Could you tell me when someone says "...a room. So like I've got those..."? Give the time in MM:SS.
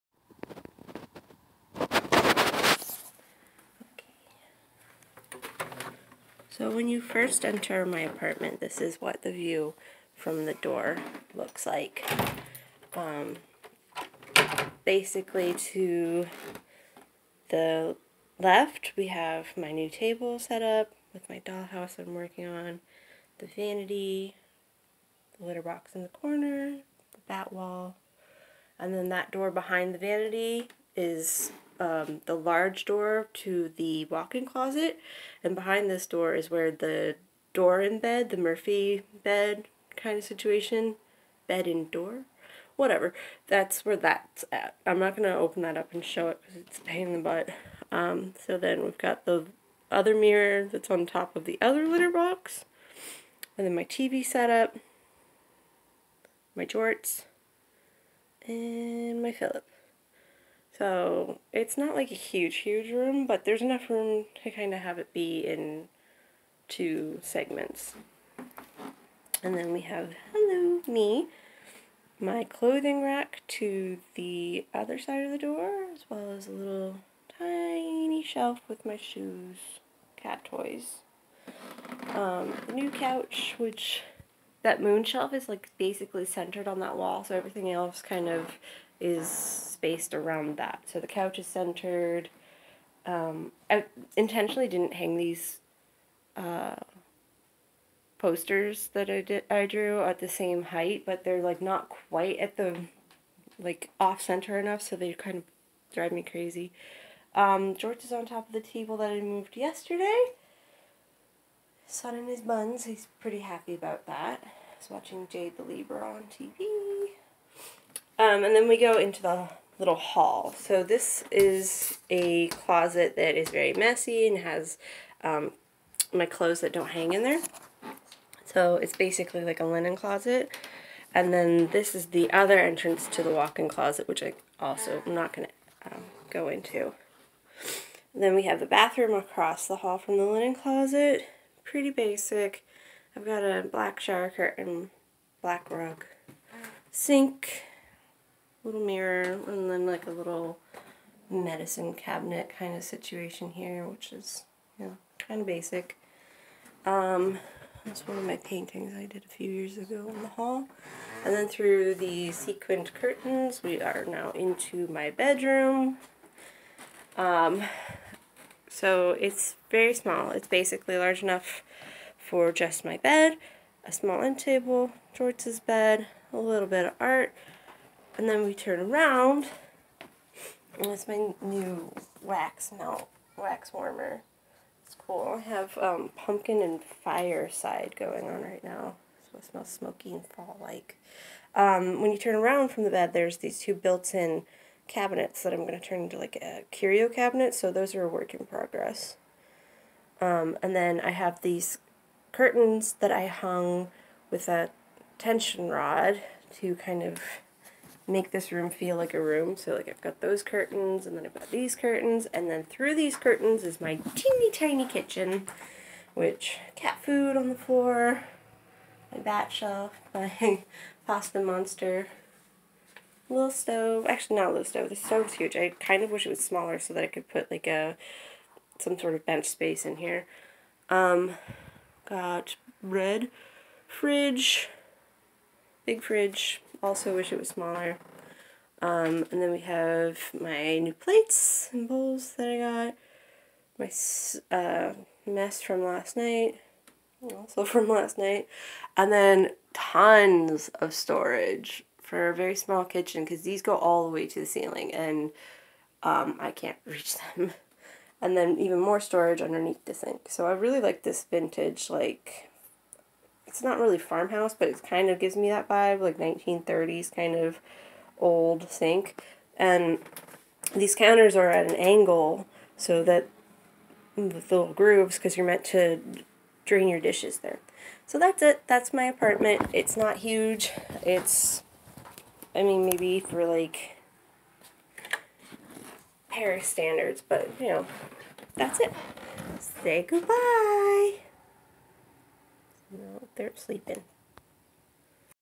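03:29.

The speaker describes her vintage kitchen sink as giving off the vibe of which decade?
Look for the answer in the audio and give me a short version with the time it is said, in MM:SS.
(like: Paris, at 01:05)
1930s, at 04:26.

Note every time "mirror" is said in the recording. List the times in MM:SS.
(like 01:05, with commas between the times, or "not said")
00:50, 02:28.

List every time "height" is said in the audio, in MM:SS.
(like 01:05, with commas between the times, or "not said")
01:40.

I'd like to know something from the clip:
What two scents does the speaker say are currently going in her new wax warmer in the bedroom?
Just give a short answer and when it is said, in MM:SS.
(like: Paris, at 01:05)
Pumpkin and fireside, at 03:06.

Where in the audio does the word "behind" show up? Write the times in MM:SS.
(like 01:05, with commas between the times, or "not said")
00:29, 00:35.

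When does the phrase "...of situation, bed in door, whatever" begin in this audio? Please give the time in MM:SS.
00:40.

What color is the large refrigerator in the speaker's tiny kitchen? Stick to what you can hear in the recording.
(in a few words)
Red.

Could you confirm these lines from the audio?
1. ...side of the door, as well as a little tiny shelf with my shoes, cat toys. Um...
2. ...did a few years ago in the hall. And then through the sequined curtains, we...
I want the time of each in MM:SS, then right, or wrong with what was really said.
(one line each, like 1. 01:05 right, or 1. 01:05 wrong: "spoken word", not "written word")
1. 01:14 right
2. 02:39 right.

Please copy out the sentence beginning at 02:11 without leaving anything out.
And then this is the other entrance to the walk-in closet, which I also am not going to um, go into.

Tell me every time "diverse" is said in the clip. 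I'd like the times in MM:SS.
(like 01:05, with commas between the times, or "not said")
not said.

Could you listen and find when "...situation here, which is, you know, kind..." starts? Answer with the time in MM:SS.
02:32.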